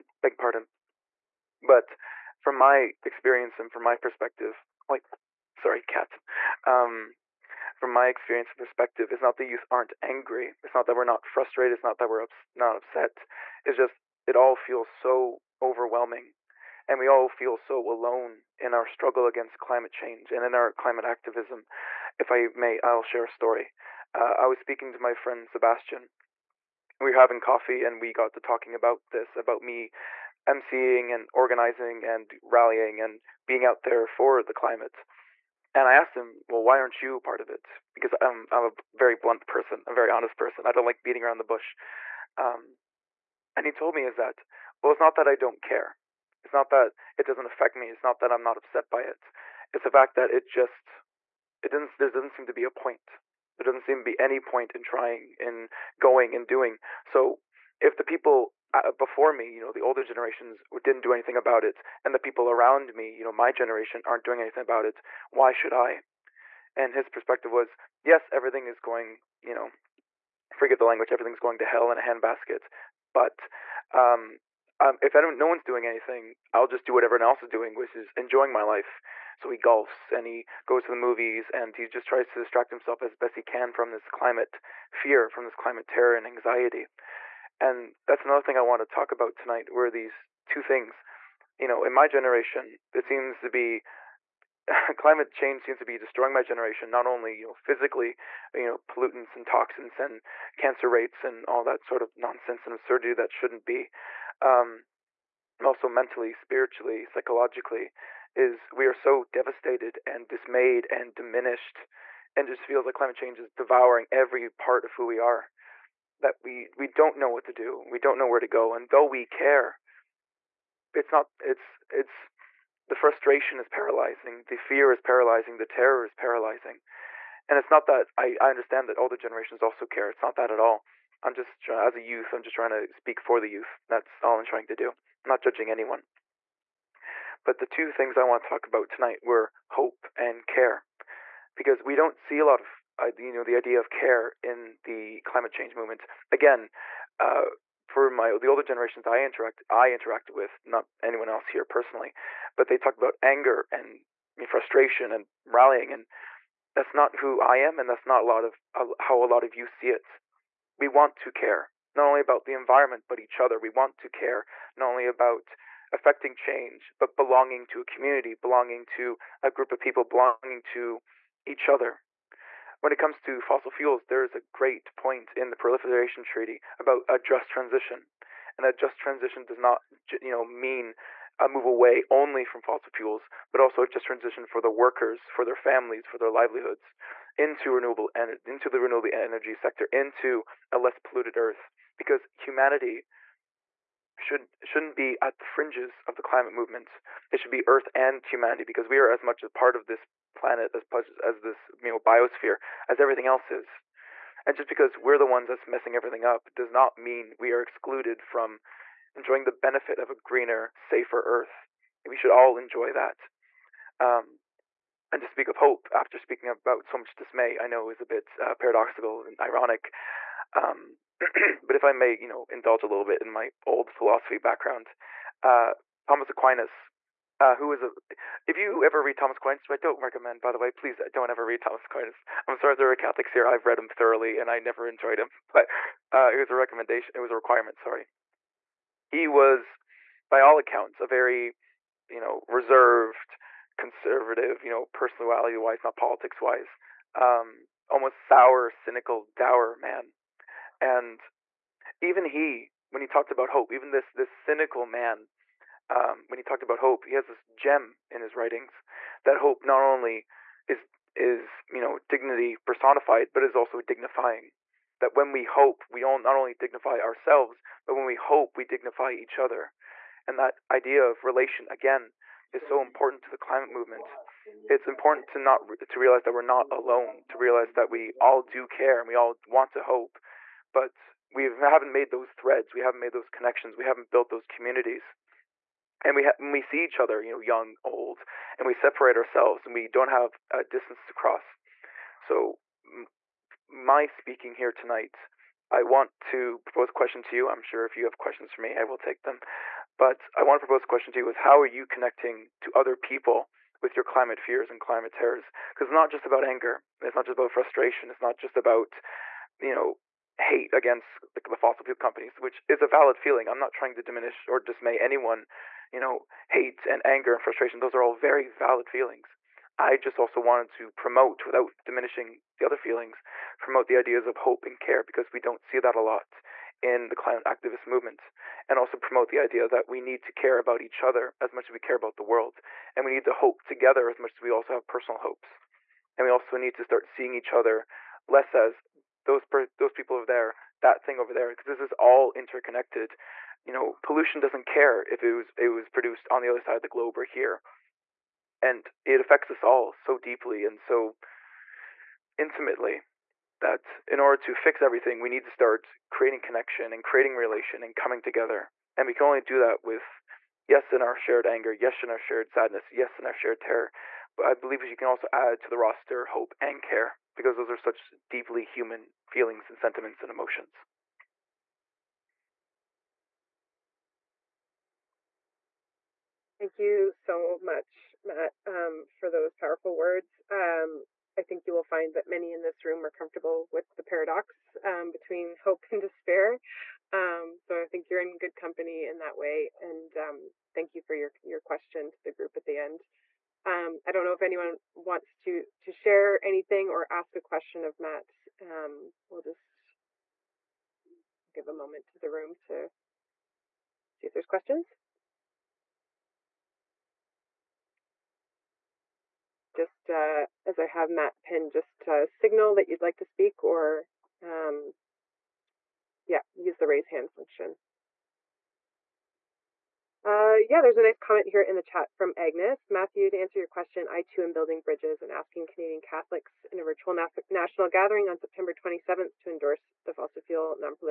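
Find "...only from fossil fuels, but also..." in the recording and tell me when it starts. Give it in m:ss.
3:02.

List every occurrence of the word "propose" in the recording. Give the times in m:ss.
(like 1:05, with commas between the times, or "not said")
4:56, 5:00.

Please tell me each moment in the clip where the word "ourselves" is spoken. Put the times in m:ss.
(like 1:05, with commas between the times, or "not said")
4:26, 4:49.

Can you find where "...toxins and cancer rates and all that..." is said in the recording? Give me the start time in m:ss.
1:39.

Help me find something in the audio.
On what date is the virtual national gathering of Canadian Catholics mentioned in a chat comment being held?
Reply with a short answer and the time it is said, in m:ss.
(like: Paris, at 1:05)
September 27, at 7:08.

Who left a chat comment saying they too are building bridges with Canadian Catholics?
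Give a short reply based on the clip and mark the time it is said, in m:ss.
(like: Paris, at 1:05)
Agnes, at 7:02.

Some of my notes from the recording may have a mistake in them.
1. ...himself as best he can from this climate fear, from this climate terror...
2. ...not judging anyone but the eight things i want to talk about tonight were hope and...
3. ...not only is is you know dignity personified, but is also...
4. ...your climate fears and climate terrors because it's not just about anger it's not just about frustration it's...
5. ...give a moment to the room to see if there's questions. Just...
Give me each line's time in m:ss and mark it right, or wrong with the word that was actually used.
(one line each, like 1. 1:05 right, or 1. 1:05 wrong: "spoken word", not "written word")
1. 1:22 right
2. 2:15 wrong: "two", not "eight"
3. 4:19 right
4. 5:03 right
5. 6:41 right.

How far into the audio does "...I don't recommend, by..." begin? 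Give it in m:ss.
3:49.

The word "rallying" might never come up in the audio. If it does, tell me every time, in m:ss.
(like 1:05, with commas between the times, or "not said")
0:32, 2:35.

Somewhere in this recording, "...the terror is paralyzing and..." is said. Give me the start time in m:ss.
2:05.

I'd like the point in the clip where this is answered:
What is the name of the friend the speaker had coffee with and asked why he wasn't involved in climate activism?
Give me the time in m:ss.
0:25.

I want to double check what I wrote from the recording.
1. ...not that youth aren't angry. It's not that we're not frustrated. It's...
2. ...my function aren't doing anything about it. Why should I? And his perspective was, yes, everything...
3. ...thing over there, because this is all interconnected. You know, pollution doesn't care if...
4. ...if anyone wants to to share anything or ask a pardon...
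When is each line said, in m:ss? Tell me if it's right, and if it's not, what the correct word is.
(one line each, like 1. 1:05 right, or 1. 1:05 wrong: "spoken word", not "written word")
1. 0:09 right
2. 1:03 wrong: "generation", not "function"
3. 5:41 right
4. 6:34 wrong: "question", not "pardon".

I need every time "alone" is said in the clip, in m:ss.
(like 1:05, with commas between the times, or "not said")
0:17, 4:36.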